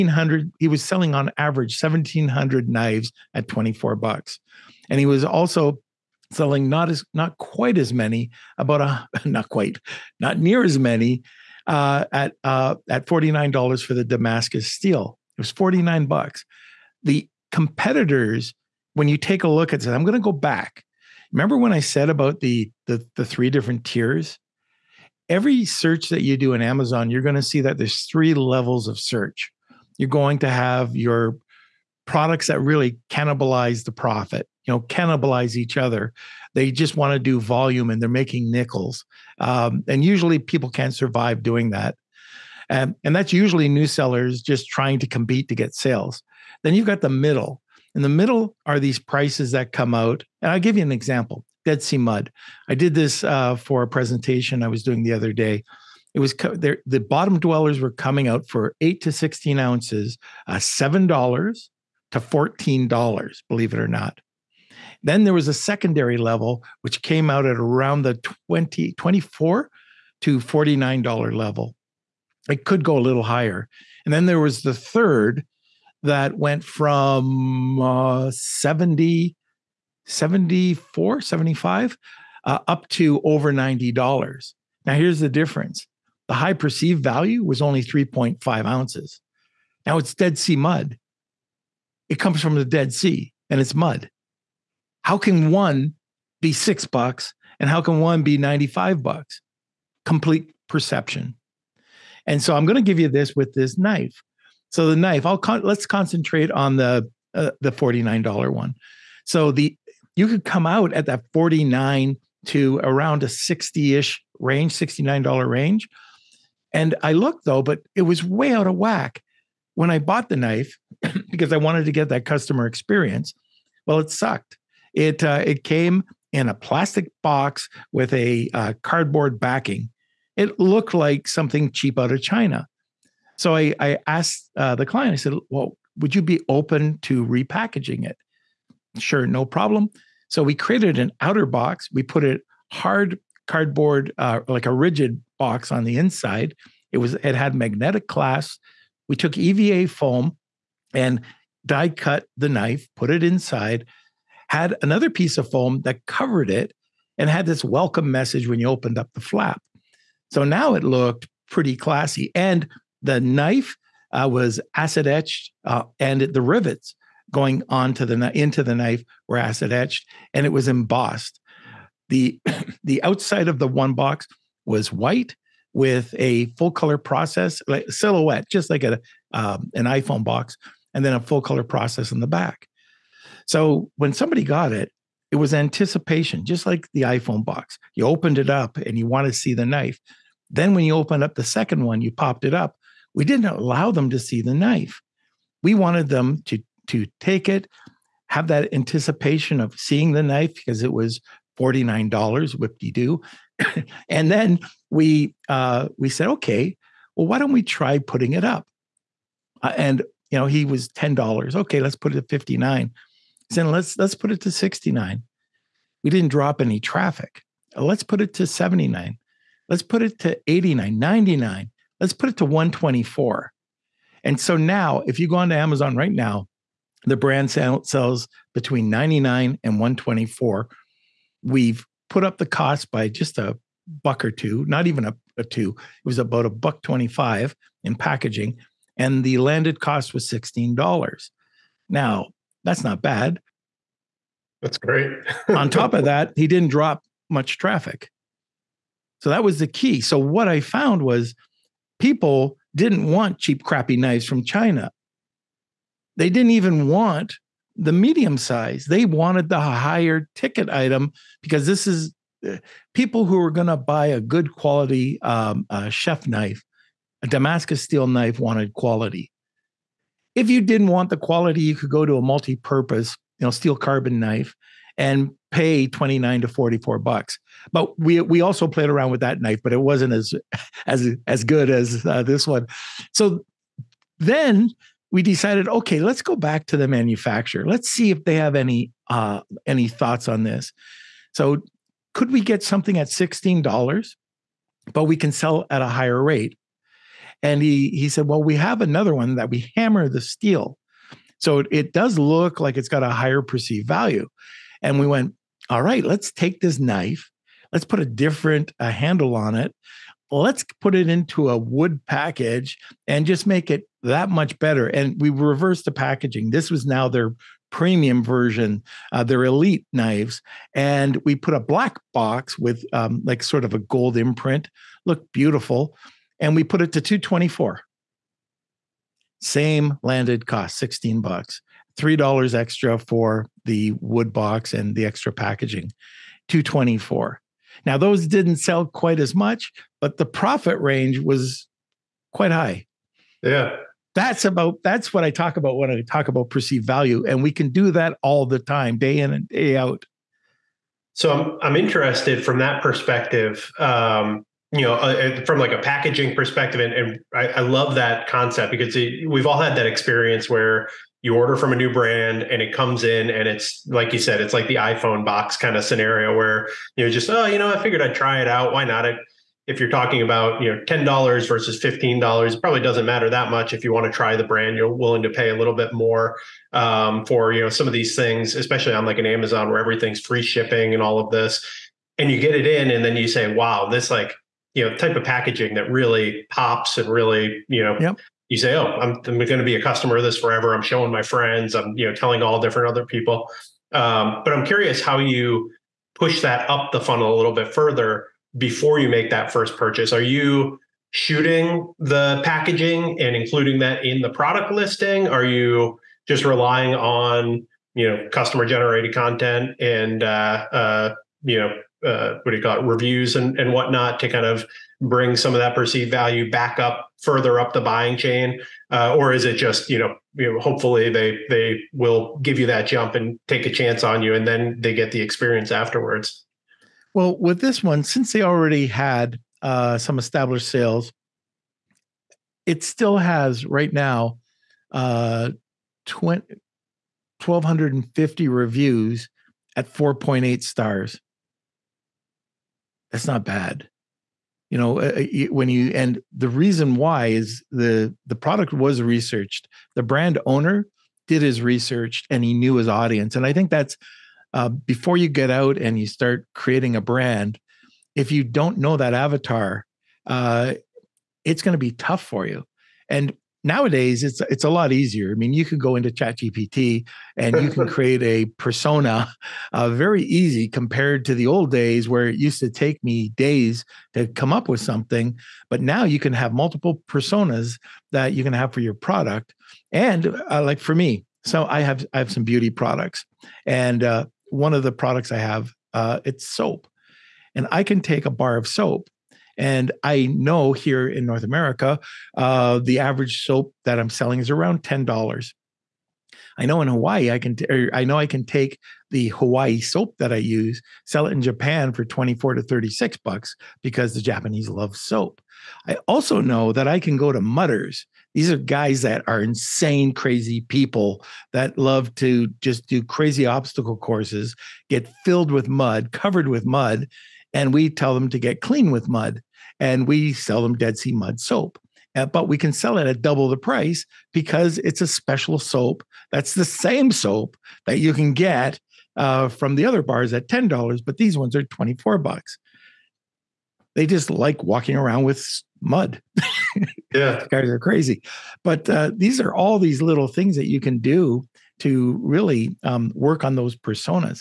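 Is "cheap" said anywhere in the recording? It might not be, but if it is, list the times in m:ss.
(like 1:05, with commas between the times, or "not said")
2:11, 4:13.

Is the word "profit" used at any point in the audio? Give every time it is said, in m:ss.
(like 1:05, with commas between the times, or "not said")
0:33, 5:40.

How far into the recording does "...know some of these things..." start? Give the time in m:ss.
6:17.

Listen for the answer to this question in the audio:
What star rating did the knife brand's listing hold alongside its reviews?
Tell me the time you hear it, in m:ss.
7:19.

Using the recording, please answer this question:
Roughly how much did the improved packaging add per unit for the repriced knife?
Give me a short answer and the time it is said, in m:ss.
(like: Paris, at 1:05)
About $1.25, at 3:56.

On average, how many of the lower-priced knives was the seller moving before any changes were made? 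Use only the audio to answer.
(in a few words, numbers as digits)
1,700.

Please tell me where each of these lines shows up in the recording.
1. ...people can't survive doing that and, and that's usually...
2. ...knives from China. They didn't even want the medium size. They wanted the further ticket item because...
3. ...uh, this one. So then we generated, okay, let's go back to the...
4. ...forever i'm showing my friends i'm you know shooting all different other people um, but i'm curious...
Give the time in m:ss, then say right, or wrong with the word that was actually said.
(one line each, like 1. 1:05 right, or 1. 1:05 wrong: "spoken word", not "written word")
1. 0:40 right
2. 4:13 wrong: "higher", not "further"
3. 4:42 wrong: "decided", not "generated"
4. 6:30 wrong: "telling", not "shooting".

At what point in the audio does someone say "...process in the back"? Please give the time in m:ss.
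3:01.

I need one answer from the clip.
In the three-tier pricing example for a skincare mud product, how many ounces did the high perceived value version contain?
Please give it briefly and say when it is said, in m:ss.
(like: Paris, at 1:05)
3.5 ounces, at 1:27.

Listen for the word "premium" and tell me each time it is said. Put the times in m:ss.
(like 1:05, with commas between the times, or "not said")
5:17.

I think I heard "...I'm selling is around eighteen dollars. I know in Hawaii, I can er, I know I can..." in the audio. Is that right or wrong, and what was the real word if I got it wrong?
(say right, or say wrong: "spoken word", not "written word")
wrong: "ten", not "eighteen".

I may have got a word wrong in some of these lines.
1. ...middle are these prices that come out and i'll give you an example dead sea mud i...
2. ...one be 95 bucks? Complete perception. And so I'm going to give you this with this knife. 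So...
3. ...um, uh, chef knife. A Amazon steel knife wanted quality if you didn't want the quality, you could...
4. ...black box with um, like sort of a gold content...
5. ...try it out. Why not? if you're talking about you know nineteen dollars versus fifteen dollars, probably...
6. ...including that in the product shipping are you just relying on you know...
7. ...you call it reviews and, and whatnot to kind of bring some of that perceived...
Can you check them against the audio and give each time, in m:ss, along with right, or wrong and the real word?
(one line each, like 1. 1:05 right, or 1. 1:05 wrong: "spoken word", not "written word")
1. 0:48 right
2. 1:38 right
3. 4:25 wrong: "Damascus", not "Amazon"
4. 5:21 wrong: "imprint", not "content"
5. 6:08 wrong: "ten", not "nineteen"
6. 6:43 wrong: "listing", not "shipping"
7. 6:52 right.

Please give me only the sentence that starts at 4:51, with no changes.
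So could we get something at $16, but we can sell at a higher rate?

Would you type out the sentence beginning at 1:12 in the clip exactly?
It could go a little higher.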